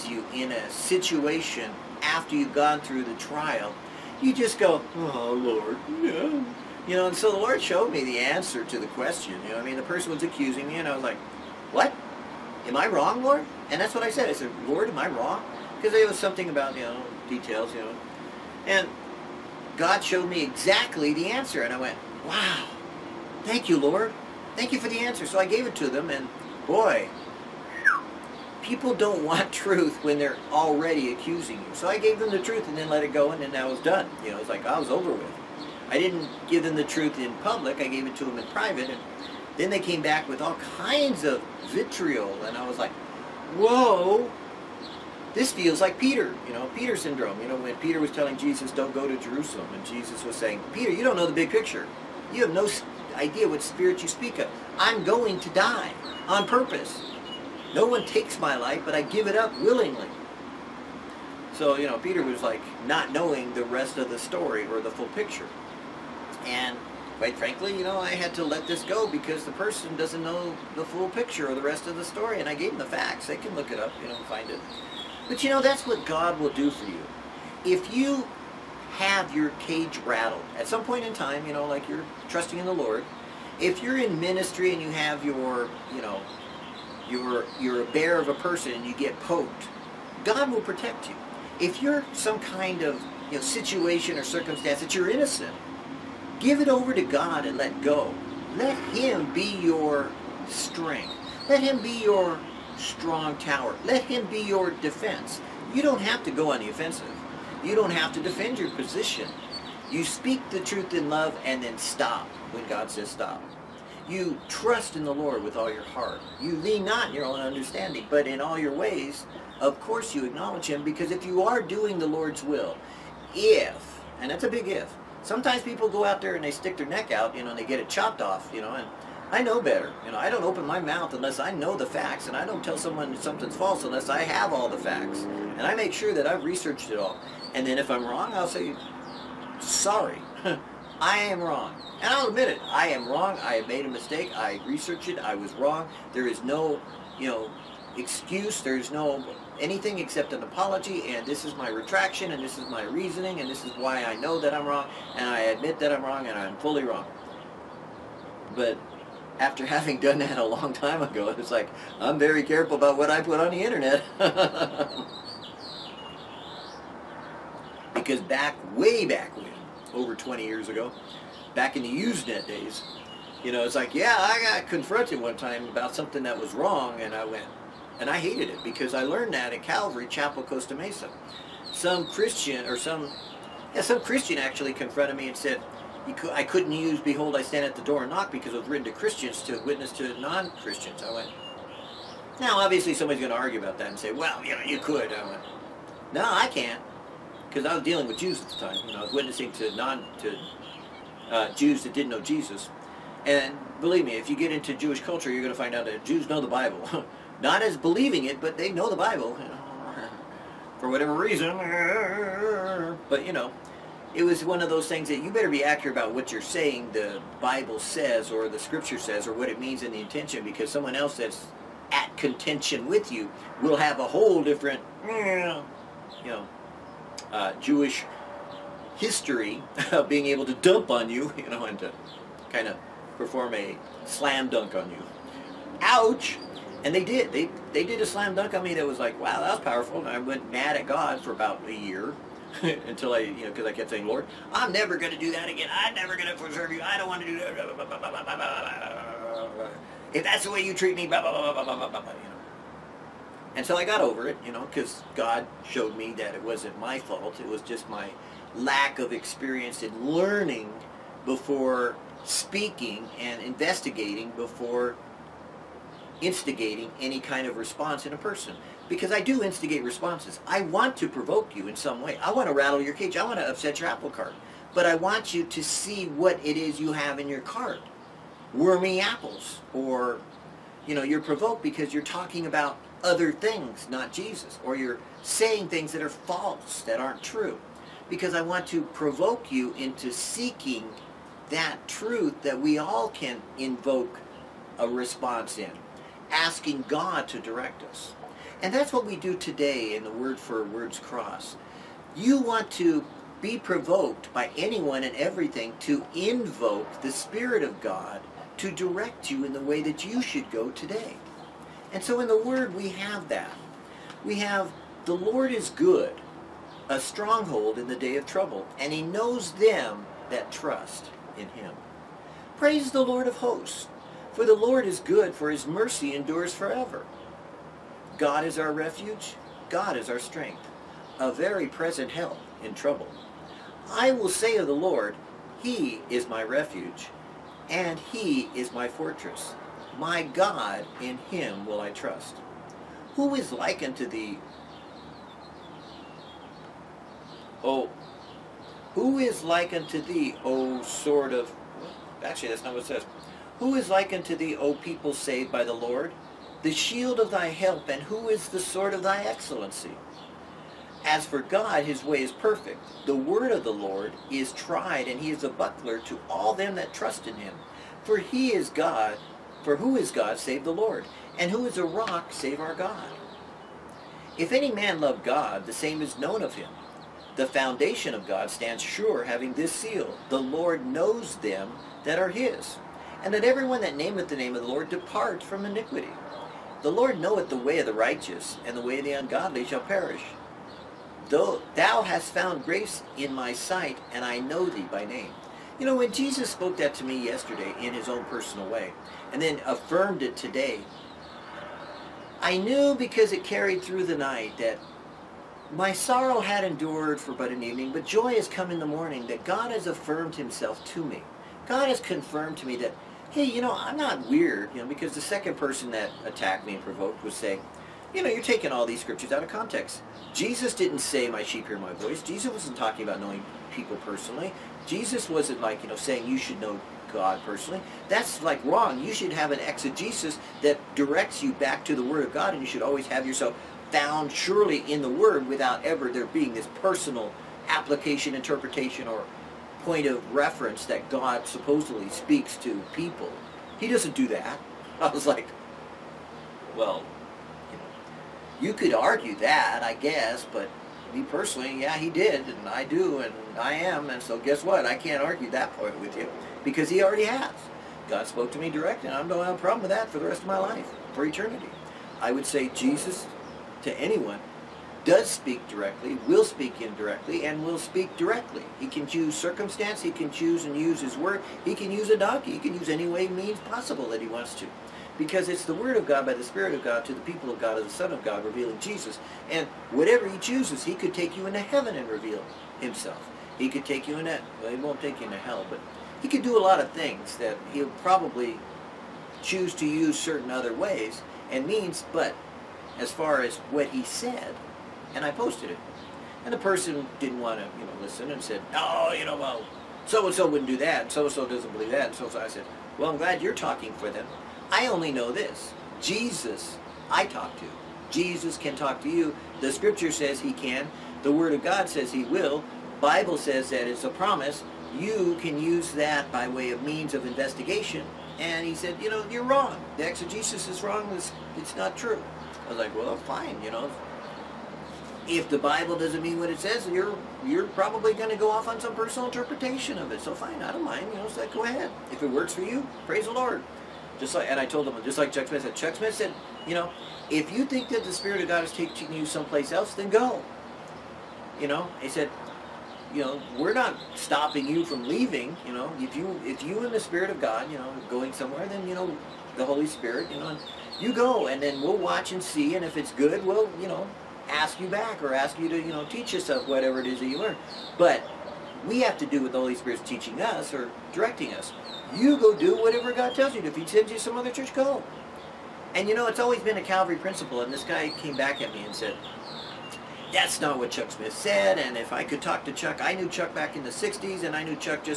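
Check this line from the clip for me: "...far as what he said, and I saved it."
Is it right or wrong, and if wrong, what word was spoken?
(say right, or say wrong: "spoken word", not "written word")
wrong: "posted", not "saved".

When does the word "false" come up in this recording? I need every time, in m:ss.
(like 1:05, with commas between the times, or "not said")
2:13, 4:46.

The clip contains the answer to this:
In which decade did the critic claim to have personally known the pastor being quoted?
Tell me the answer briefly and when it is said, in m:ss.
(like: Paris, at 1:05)
The 1960s, at 9:33.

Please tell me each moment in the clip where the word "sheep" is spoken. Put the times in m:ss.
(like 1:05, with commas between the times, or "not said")
7:01.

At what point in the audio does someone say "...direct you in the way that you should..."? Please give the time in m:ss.
5:08.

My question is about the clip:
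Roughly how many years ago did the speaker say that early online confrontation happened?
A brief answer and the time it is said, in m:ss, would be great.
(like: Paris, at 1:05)
over 20 years, at 2:49.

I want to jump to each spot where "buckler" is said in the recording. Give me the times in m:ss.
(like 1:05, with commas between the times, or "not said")
6:05.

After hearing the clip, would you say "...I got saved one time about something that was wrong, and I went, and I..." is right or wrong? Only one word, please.
wrong.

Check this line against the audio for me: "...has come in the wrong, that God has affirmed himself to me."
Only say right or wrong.
wrong.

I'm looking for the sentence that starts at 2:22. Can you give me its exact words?
And I'll admit it, I am wrong, I have made a mistake, I researched it, I was wrong.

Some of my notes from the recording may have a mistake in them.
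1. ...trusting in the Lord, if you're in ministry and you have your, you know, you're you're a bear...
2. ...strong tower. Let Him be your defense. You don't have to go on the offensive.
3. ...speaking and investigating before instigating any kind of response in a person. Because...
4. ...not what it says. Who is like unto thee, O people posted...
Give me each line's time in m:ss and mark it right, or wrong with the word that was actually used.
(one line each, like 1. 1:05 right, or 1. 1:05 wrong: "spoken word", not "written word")
1. 1:22 right
2. 1:42 right
3. 4:22 right
4. 5:52 wrong: "saved", not "posted".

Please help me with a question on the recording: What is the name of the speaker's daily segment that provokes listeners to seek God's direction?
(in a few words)
Word for Woods Cross.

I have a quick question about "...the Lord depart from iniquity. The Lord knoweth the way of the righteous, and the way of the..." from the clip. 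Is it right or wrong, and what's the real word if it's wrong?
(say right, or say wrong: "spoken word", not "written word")
right.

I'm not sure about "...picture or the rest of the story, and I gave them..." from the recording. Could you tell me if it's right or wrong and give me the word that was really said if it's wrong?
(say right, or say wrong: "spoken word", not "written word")
right.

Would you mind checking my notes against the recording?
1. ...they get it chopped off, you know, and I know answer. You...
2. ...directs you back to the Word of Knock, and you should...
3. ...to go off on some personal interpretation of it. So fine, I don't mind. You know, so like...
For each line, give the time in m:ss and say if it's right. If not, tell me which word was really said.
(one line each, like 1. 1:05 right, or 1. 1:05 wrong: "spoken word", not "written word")
1. 2:07 wrong: "better", not "answer"
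2. 7:10 wrong: "God", not "Knock"
3. 8:48 right.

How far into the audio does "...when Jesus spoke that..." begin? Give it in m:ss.
6:35.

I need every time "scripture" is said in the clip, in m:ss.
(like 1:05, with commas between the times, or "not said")
3:38, 6:59, 8:29.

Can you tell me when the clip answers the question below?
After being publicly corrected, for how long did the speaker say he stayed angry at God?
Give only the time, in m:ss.
4:01.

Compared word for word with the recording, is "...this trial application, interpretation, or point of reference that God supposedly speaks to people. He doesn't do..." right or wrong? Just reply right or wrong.
wrong.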